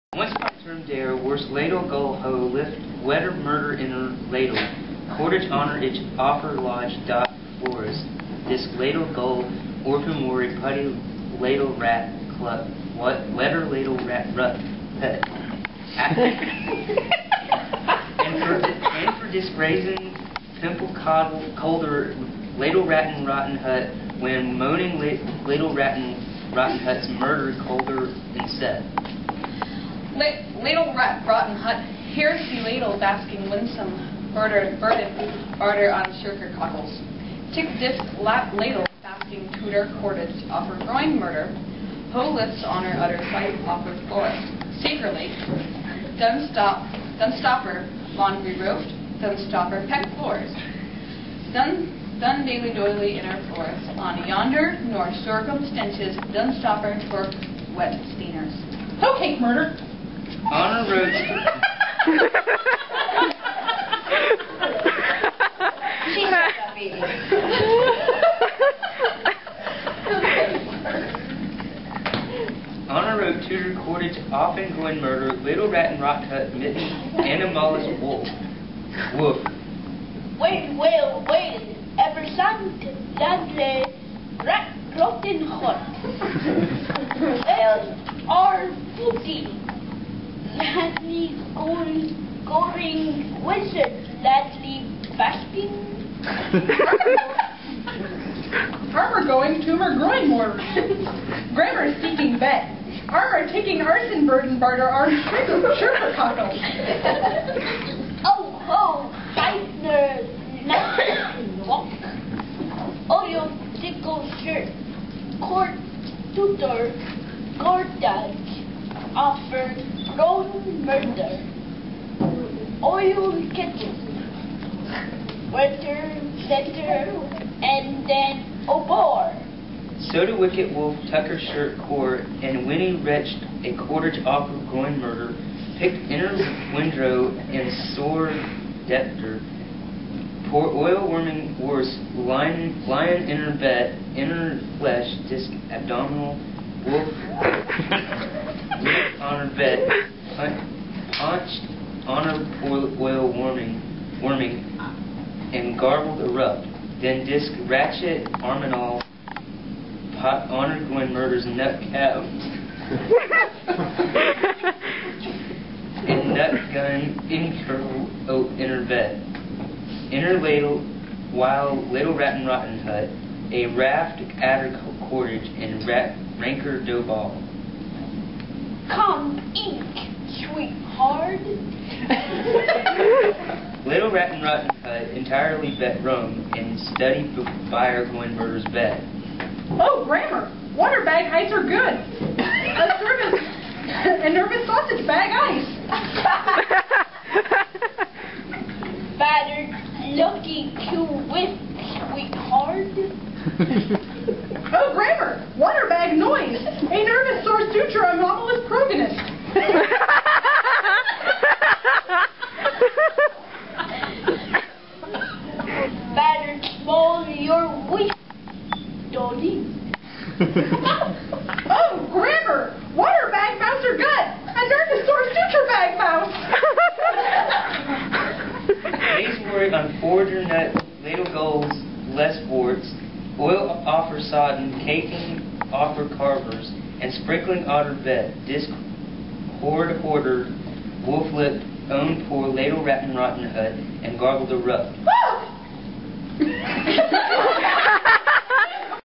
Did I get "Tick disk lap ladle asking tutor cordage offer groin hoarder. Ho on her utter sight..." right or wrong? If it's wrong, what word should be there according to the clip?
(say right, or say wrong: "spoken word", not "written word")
wrong: "murder", not "hoarder".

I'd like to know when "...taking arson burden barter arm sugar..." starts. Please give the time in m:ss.
1:43.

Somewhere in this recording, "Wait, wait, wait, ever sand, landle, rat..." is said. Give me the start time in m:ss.
1:20.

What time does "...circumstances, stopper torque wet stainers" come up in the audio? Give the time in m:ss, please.
0:55.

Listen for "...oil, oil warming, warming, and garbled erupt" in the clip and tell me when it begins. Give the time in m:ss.
2:32.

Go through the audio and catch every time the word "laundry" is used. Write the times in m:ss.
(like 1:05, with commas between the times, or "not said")
0:48.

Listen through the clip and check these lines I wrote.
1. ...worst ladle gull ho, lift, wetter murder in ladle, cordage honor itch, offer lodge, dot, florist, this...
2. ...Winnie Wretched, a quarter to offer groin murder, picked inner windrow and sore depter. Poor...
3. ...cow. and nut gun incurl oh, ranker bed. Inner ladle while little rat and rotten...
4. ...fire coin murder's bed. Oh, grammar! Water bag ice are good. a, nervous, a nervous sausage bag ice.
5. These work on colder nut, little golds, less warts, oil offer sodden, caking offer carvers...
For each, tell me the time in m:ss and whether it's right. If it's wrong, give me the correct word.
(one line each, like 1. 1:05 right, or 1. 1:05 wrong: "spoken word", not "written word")
1. 0:01 wrong: "forest", not "florist"
2. 2:12 right
3. 2:41 wrong: "inner", not "ranker"
4. 3:07 right
5. 3:49 wrong: "forger", not "colder".